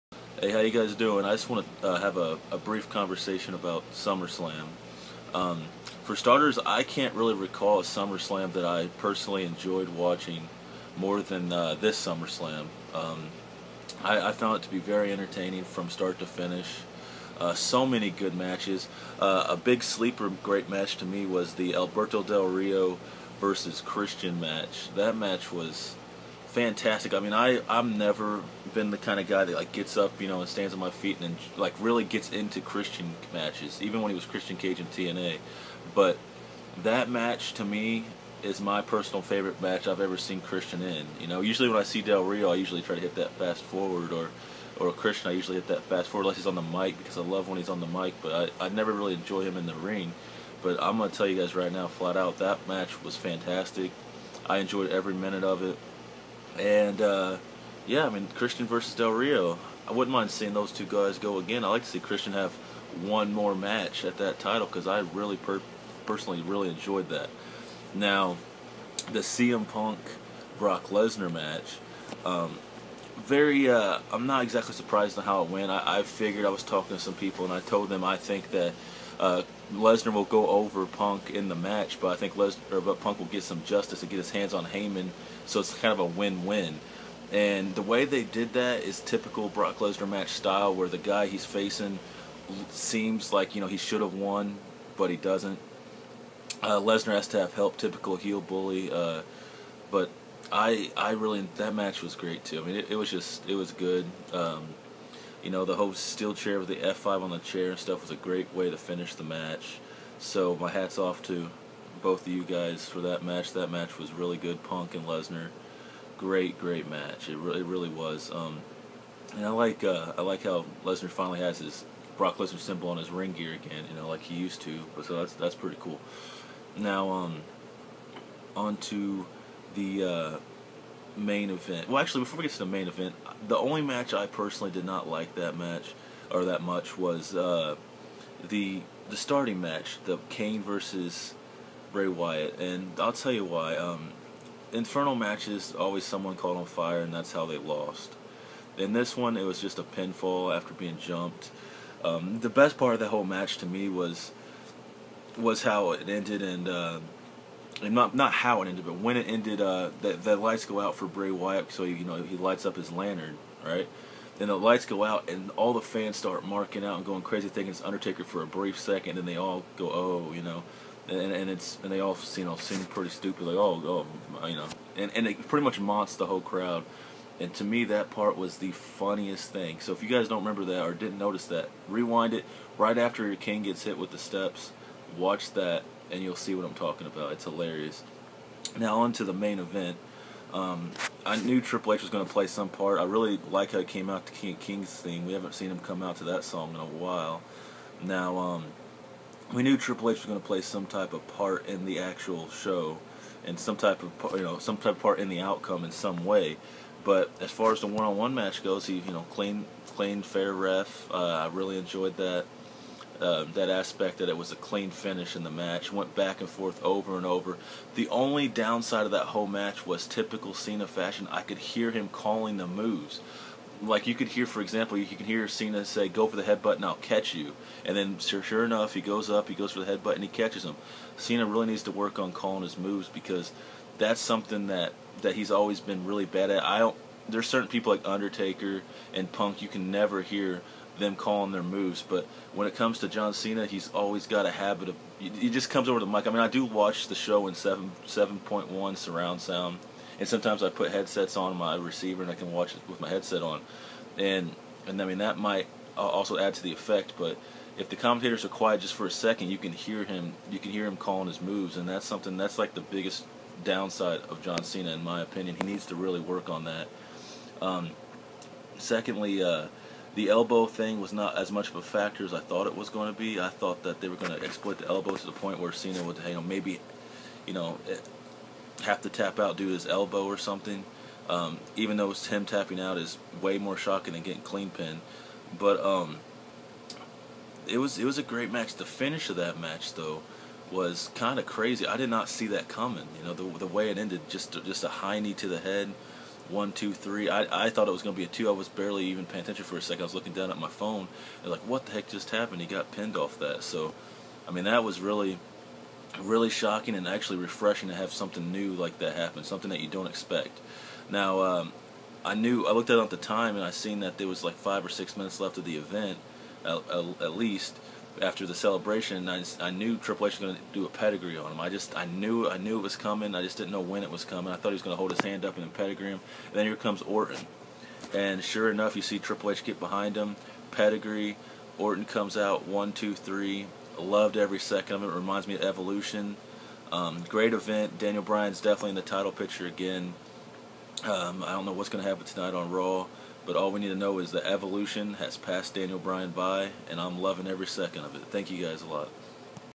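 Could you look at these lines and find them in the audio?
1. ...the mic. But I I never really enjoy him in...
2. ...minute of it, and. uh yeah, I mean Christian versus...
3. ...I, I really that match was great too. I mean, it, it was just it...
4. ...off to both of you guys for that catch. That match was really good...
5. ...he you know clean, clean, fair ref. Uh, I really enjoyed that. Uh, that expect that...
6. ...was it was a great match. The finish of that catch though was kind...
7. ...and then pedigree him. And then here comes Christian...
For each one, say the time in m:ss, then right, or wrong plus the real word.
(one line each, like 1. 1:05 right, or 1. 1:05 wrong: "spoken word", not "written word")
1. 0:47 right
2. 0:55 right
3. 1:40 right
4. 1:50 wrong: "match", not "catch"
5. 3:28 wrong: "aspect", not "expect"
6. 4:47 wrong: "match", not "catch"
7. 5:25 wrong: "Orton", not "Christian".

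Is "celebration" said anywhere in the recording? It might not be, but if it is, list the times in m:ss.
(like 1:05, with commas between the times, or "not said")
5:18.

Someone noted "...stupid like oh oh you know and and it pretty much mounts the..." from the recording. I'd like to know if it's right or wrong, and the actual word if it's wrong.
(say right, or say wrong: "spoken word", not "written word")
right.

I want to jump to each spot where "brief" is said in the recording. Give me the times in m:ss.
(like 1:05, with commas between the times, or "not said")
0:02, 2:48.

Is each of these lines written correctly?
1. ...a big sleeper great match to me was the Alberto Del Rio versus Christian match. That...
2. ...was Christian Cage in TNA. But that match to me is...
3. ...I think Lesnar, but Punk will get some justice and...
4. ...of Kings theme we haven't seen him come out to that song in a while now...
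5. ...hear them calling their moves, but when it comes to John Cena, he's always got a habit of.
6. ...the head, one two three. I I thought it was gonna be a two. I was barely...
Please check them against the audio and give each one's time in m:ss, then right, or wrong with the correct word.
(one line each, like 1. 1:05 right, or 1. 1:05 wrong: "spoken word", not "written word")
1. 0:19 right
2. 0:34 right
3. 1:22 right
4. 3:14 right
5. 4:00 right
6. 4:55 right.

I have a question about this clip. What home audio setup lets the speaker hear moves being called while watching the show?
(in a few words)
7.1 surround sound.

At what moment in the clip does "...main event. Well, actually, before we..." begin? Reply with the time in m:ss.
2:11.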